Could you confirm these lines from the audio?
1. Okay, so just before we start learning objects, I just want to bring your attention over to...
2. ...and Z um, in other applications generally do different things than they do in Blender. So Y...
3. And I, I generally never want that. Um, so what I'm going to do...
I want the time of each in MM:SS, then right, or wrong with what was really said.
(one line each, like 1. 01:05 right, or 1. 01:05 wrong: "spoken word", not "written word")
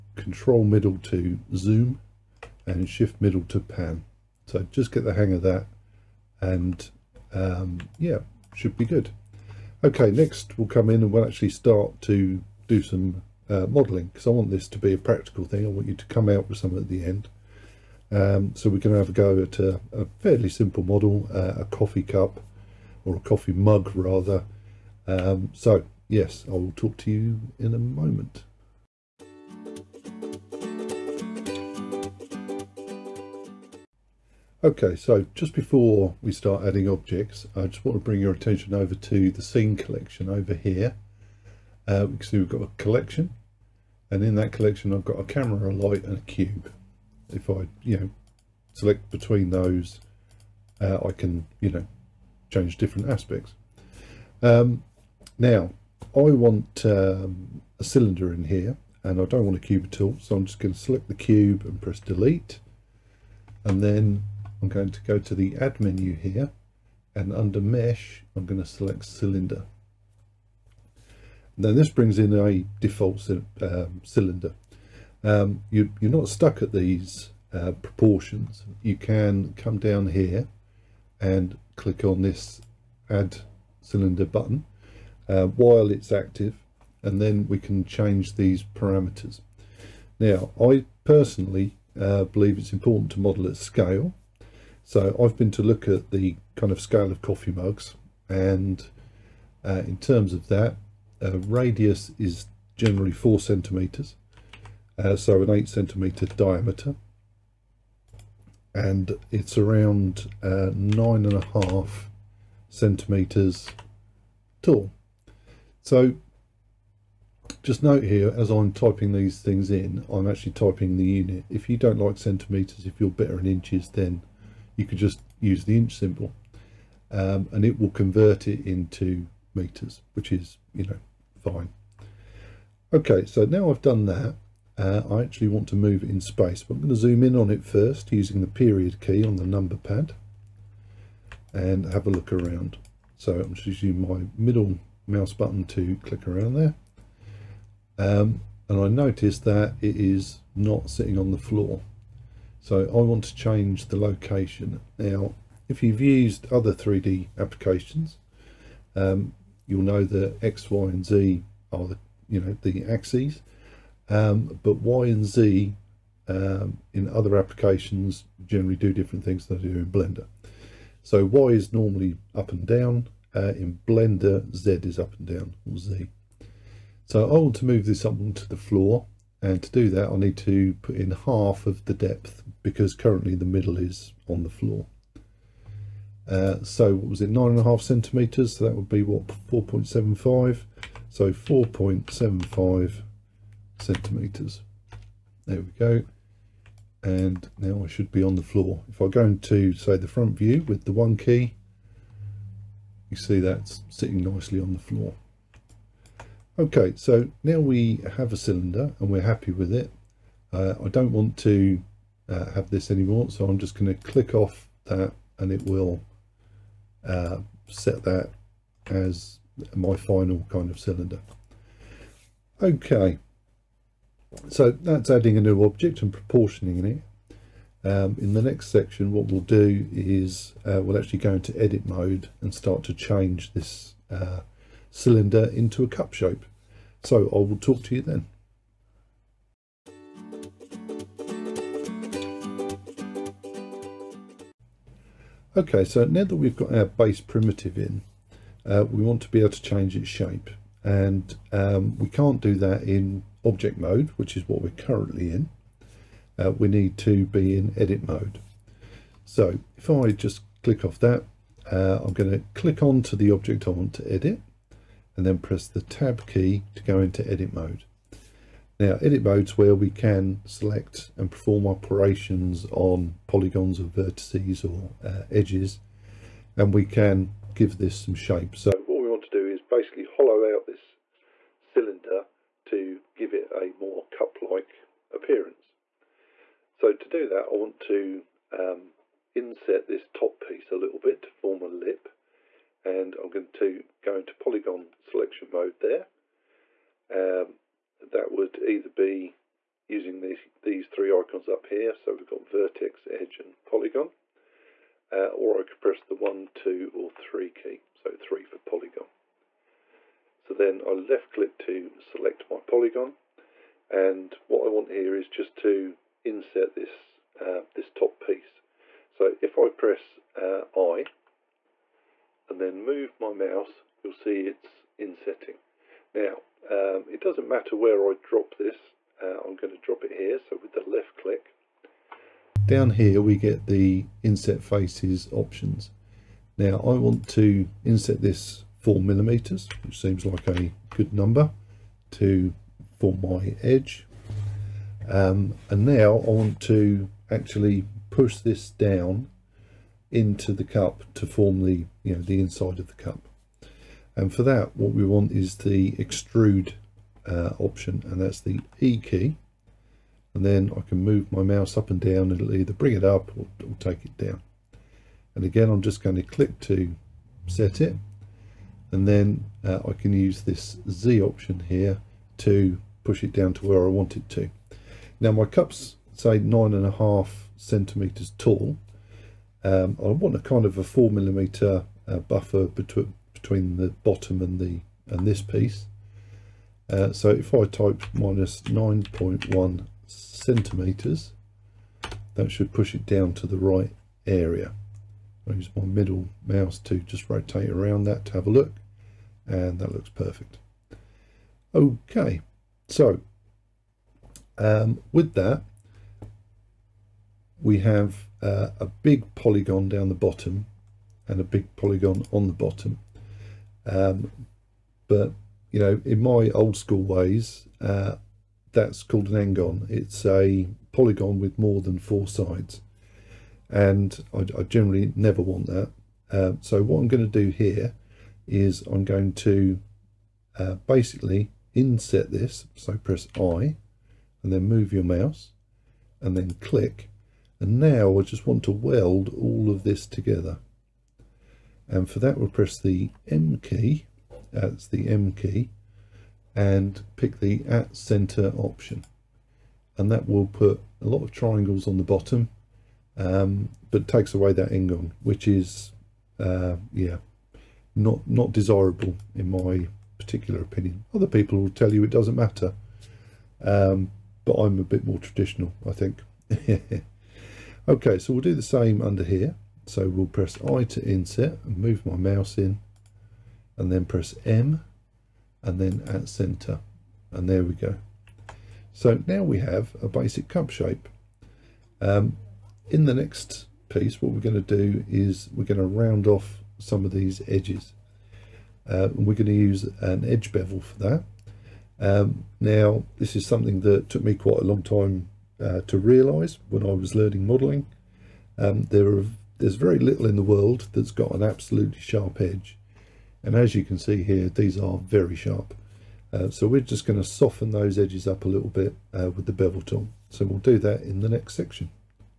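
1. 00:34 wrong: "adding", not "learning"
2. 02:45 right
3. 07:03 right.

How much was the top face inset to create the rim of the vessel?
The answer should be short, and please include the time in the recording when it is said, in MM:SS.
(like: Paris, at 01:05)
4 millimeters, at 05:38.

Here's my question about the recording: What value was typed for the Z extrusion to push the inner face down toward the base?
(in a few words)
-9.1 centimeters.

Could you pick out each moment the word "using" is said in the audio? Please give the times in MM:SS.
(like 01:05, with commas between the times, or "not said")
02:18, 02:23, 04:59.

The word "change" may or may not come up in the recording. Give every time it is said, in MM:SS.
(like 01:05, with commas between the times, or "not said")
00:52, 01:27, 02:33, 03:52, 04:09.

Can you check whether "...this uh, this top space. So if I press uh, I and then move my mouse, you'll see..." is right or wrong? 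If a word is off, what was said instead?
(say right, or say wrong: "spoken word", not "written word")
wrong: "piece", not "space".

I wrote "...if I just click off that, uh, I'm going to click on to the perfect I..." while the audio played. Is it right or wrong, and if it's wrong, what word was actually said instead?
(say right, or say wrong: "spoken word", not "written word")
wrong: "object", not "perfect".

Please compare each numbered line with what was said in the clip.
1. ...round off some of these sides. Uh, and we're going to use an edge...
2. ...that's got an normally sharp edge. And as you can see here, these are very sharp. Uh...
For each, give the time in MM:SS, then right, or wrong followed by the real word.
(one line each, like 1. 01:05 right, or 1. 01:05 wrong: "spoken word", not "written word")
1. 08:05 wrong: "edges", not "sides"
2. 08:20 wrong: "absolutely", not "normally".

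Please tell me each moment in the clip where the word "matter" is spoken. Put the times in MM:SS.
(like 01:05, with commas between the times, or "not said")
05:27, 07:42.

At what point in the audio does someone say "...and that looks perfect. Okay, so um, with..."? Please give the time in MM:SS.
06:39.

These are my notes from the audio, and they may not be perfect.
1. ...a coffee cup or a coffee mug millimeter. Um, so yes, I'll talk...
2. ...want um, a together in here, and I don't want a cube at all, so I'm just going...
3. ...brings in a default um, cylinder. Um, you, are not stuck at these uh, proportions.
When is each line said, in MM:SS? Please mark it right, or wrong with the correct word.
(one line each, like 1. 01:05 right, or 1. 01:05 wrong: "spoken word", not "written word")
1. 00:21 wrong: "rather", not "millimeter"
2. 00:56 wrong: "cylinder", not "together"
3. 01:11 right.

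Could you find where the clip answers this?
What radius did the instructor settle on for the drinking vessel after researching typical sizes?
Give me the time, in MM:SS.
01:43.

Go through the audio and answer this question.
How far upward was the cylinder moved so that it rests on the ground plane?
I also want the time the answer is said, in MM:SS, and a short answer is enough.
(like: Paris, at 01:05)
4.75 centimeters, at 03:11.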